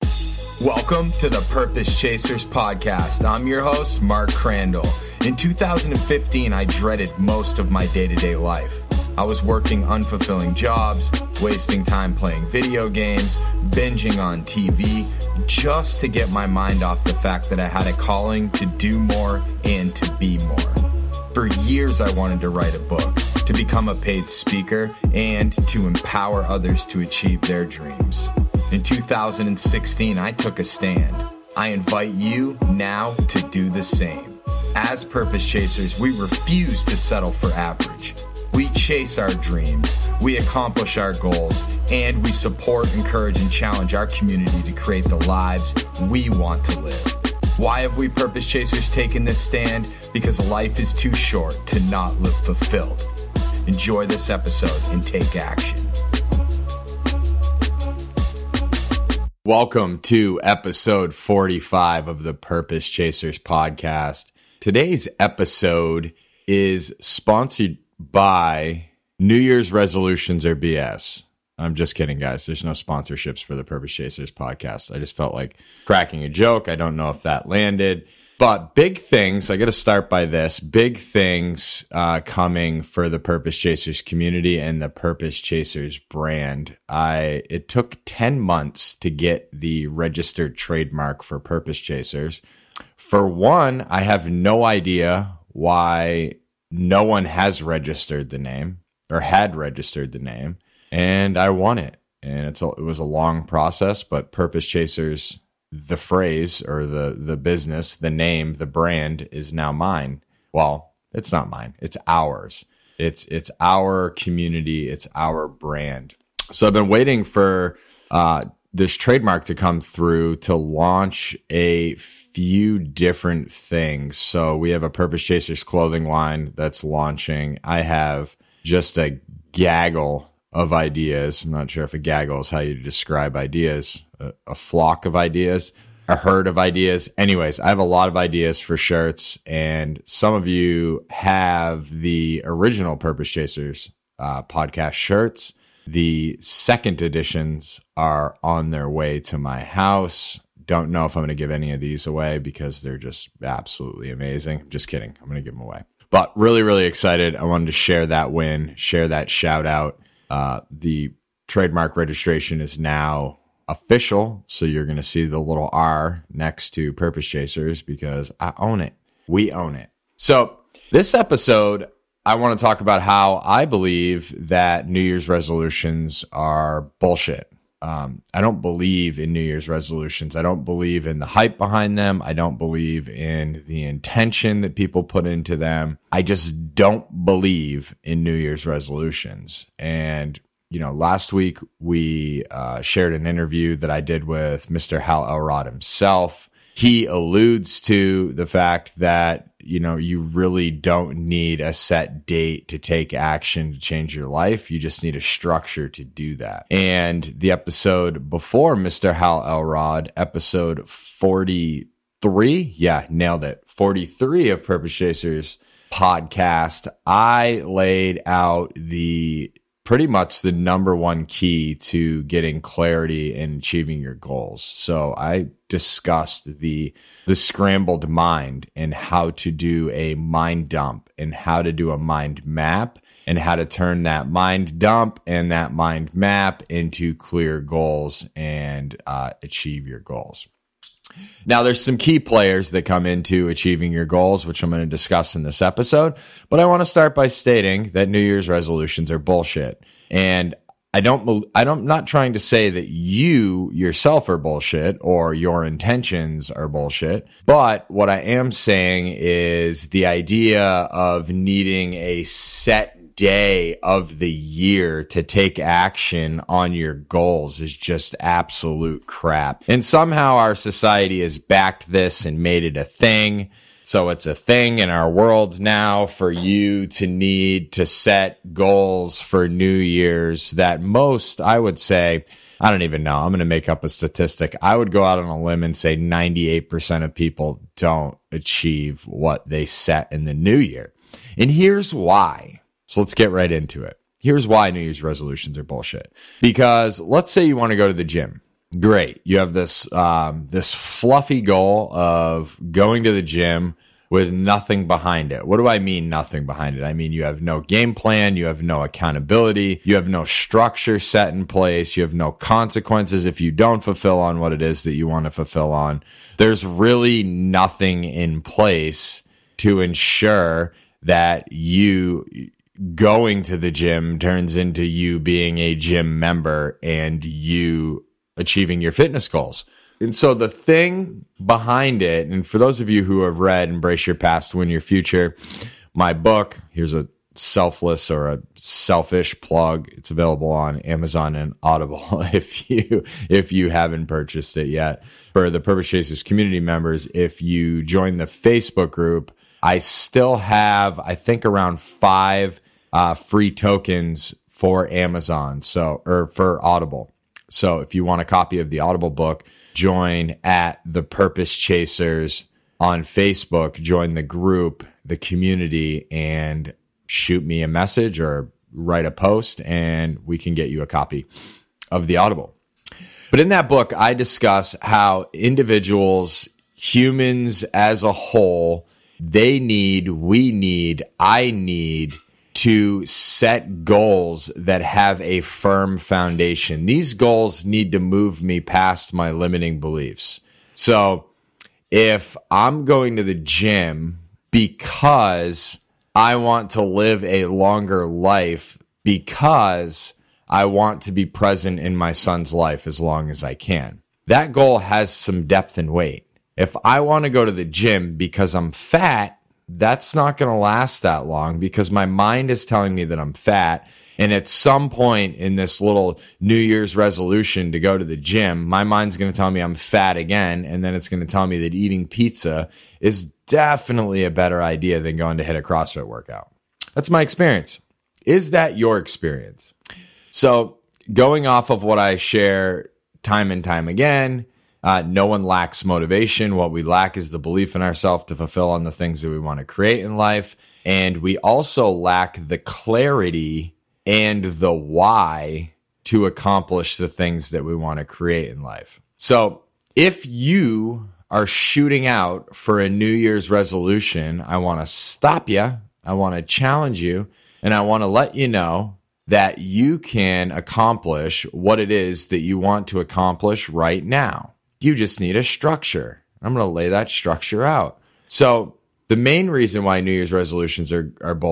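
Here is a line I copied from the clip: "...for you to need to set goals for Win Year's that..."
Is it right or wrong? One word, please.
wrong.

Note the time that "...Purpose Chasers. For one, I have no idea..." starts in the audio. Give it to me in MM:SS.
01:31.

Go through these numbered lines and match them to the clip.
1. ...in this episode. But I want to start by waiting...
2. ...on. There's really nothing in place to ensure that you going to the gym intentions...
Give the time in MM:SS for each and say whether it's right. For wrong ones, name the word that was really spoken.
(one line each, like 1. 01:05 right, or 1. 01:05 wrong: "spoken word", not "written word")
1. 04:05 wrong: "stating", not "waiting"
2. 05:15 wrong: "turns", not "intentions".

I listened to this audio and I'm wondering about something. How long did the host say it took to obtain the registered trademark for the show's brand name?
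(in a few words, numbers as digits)
10 months.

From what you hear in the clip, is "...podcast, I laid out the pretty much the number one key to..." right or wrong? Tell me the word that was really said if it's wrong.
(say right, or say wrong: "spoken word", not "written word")
right.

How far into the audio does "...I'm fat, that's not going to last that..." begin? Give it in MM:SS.
06:48.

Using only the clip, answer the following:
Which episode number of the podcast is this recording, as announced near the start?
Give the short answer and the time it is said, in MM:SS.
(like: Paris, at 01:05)
45, at 01:00.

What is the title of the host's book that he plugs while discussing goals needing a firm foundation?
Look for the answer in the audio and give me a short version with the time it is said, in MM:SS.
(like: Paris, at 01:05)
Embrace Your Past, Win Your Future, at 05:33.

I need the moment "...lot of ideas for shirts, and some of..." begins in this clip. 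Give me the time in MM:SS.
02:17.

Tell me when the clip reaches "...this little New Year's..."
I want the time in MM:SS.
06:55.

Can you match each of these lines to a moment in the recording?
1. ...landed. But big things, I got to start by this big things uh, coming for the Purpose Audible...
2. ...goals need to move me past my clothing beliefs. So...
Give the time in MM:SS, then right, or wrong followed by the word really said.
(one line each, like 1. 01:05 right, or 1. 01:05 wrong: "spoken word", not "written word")
1. 01:17 wrong: "Chasers", not "Audible"
2. 06:27 wrong: "limiting", not "clothing".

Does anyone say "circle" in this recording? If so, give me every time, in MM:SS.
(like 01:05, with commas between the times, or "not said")
not said.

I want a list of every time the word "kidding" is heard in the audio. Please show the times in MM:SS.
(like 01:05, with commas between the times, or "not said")
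01:11, 02:34.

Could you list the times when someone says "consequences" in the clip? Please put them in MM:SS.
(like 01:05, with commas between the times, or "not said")
05:12.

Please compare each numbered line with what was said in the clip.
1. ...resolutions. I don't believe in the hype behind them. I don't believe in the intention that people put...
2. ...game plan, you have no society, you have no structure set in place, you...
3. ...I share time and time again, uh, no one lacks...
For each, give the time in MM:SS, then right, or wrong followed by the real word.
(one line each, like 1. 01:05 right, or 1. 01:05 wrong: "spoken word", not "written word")
1. 02:59 right
2. 05:07 wrong: "accountability", not "society"
3. 07:11 right.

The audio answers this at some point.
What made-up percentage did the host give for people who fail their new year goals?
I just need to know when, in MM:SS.
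04:45.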